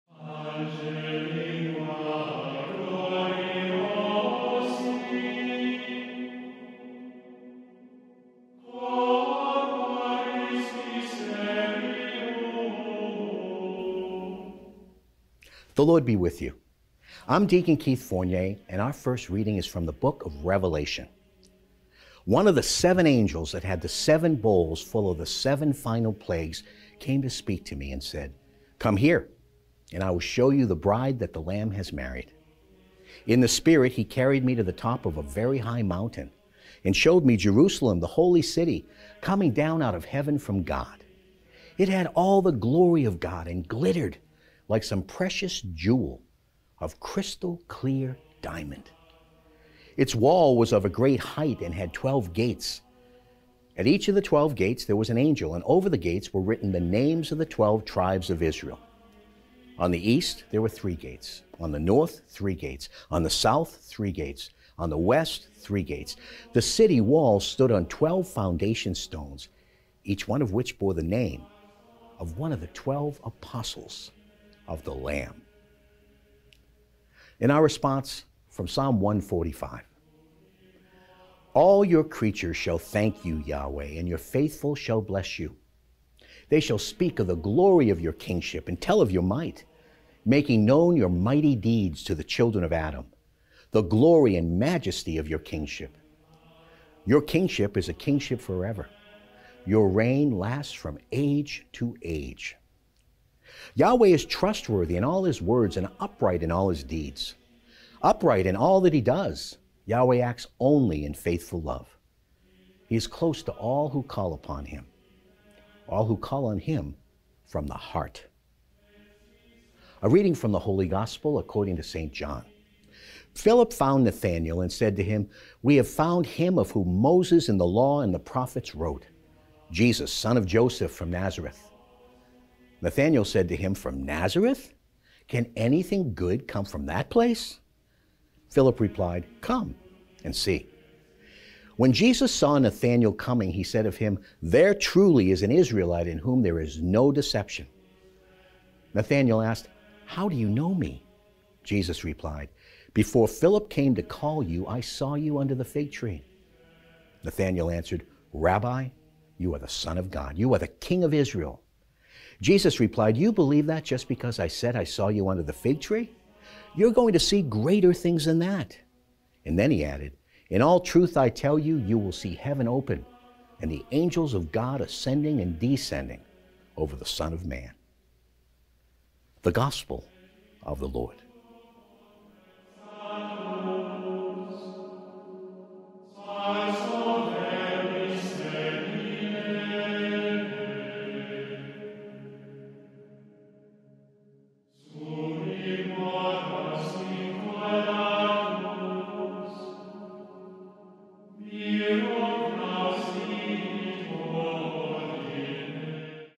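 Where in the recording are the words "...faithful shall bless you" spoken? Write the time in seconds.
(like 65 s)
84 s.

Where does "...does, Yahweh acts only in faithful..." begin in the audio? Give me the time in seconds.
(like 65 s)
109 s.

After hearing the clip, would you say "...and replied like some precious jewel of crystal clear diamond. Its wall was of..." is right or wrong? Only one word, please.
wrong.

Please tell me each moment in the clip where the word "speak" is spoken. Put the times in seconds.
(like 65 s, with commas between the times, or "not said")
27 s, 86 s.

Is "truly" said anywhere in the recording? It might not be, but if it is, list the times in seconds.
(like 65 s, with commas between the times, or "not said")
144 s.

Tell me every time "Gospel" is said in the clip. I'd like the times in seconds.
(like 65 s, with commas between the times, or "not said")
120 s, 179 s.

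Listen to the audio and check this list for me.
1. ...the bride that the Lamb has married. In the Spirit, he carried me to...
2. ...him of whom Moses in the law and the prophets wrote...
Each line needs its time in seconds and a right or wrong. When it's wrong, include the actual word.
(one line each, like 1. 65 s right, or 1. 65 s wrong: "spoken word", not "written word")
1. 30 s right
2. 126 s right.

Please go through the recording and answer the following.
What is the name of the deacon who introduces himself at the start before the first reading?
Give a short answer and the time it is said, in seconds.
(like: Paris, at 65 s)
Keith Fournier, at 17 s.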